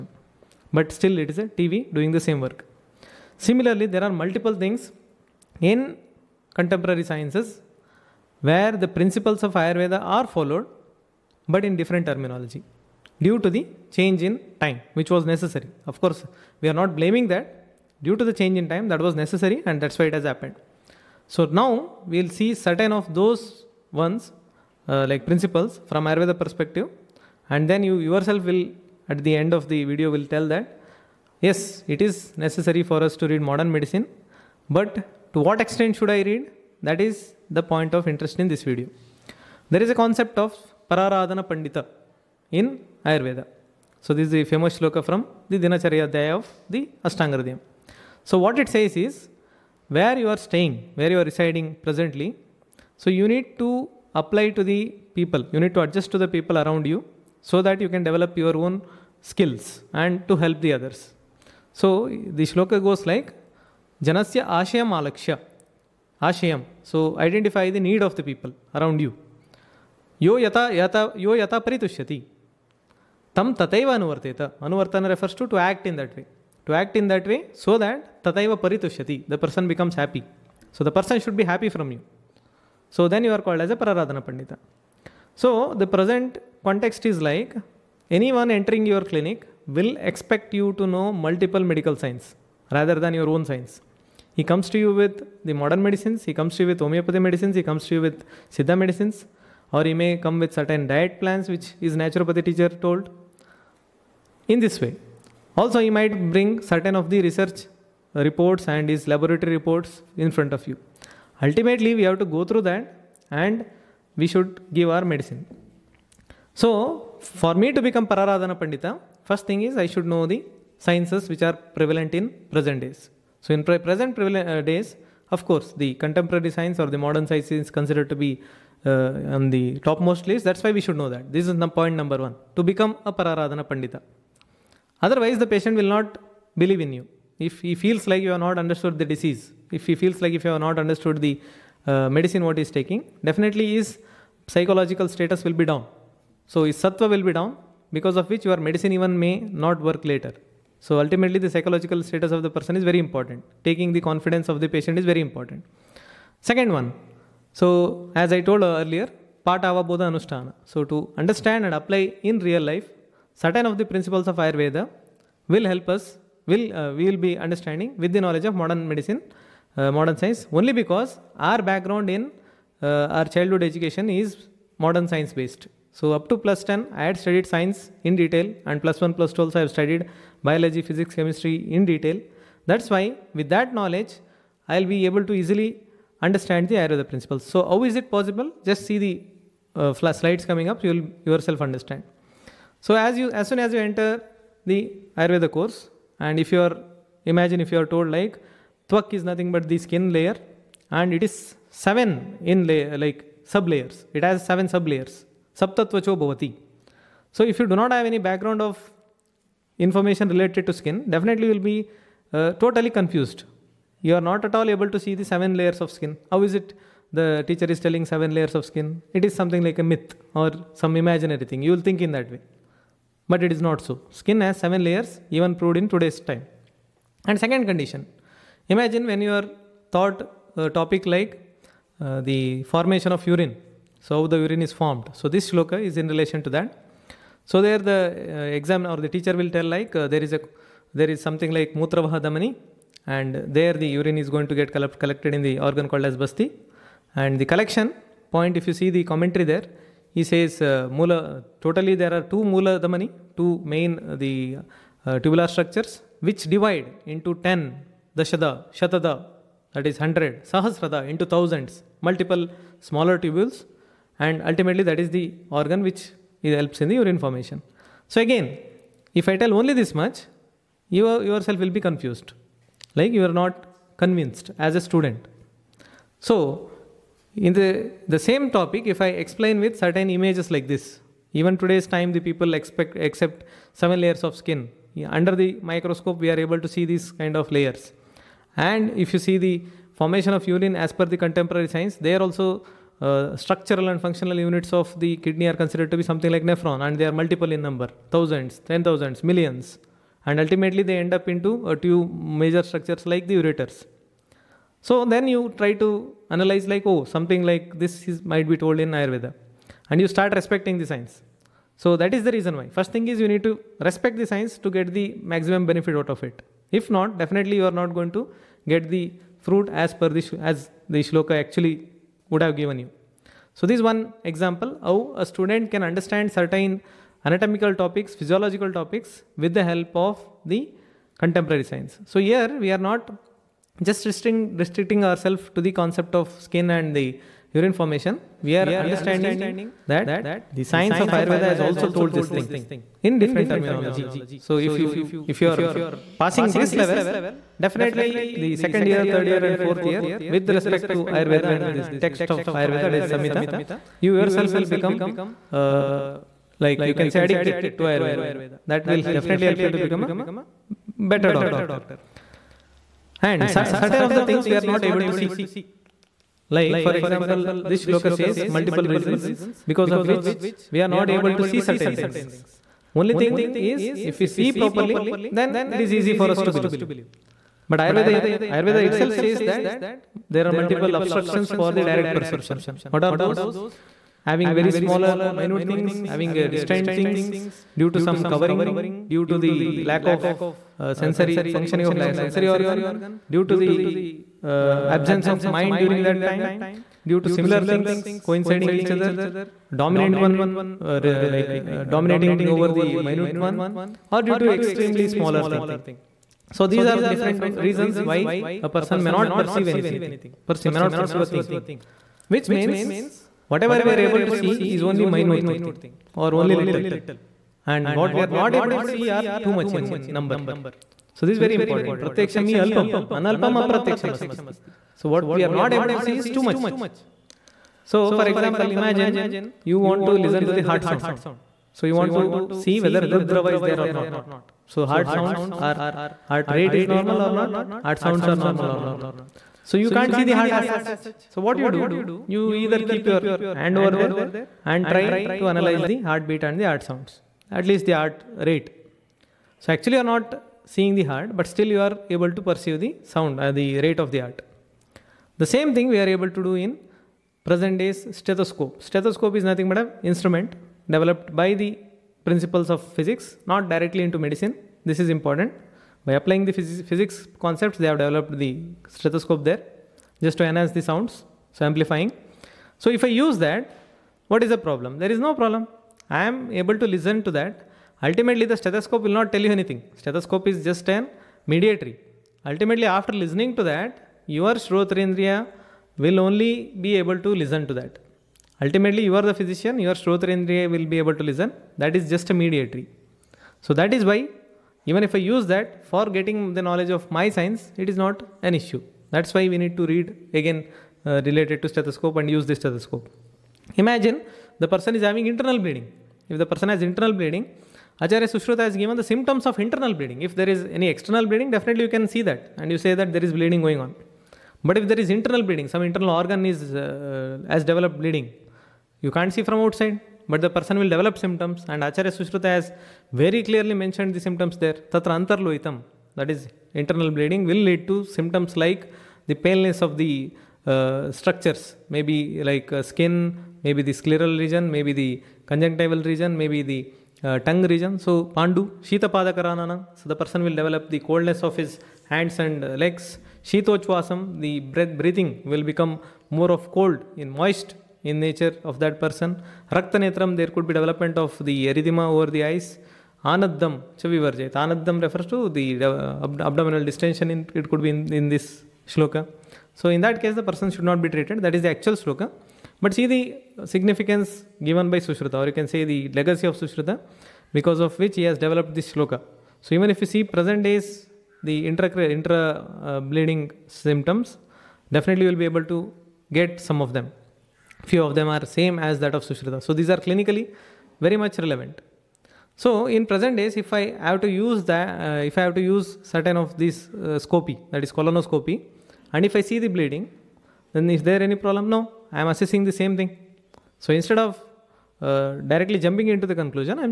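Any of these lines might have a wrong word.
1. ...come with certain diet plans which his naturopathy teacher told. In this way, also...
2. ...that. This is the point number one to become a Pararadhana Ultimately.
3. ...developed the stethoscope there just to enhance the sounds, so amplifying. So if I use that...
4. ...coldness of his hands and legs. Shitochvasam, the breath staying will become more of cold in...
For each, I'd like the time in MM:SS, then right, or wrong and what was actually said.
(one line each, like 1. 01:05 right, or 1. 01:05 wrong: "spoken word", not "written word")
1. 01:40 right
2. 02:11 wrong: "Pandita", not "Ultimately"
3. 07:48 right
4. 09:00 wrong: "breathing", not "staying".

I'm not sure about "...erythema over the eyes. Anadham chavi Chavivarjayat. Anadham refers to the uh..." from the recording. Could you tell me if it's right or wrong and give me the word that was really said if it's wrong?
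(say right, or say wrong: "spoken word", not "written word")
right.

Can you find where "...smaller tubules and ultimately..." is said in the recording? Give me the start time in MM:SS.
04:22.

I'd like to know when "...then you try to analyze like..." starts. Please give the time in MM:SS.
05:05.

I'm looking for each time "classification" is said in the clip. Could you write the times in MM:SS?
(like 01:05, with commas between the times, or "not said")
not said.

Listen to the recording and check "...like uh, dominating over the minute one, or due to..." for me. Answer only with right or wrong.
right.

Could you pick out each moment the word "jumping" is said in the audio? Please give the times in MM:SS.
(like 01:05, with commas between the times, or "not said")
09:55.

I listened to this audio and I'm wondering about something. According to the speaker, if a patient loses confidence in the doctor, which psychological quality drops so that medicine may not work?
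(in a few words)
sattva.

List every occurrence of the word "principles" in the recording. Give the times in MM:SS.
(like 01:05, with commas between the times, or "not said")
00:08, 00:25, 02:43, 03:07, 07:42.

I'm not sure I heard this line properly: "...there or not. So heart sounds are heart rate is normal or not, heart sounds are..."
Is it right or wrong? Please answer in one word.
right.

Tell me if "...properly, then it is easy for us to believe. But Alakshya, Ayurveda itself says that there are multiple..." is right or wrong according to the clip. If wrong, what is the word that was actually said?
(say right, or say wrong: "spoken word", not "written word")
wrong: "Ayurveda", not "Alakshya".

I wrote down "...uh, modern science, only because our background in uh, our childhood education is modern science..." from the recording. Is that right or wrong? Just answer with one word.
right.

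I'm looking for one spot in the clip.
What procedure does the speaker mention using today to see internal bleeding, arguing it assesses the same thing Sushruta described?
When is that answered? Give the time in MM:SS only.
09:47.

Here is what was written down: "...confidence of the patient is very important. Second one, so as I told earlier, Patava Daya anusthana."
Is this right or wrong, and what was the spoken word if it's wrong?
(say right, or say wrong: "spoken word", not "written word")
wrong: "Bodha", not "Daya".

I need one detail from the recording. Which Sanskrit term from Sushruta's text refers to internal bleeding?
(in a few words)
antarloitam.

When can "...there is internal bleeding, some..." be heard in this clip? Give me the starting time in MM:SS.
08:34.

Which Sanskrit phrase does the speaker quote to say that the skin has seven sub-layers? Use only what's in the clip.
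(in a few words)
Saptatvacho bhavati.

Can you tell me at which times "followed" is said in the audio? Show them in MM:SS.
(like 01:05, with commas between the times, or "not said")
00:10.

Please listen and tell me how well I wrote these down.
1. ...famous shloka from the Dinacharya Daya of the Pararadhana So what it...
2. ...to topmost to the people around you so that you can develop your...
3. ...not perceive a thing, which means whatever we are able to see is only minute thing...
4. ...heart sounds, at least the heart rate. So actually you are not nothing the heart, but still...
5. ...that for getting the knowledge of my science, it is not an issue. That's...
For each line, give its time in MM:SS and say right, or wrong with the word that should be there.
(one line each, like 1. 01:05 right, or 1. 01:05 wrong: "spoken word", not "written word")
1. 00:44 wrong: "Ashtanga", not "Pararadhana"
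2. 00:55 wrong: "adjust", not "topmost"
3. 06:50 right
4. 07:26 wrong: "seeing", not "nothing"
5. 08:15 right.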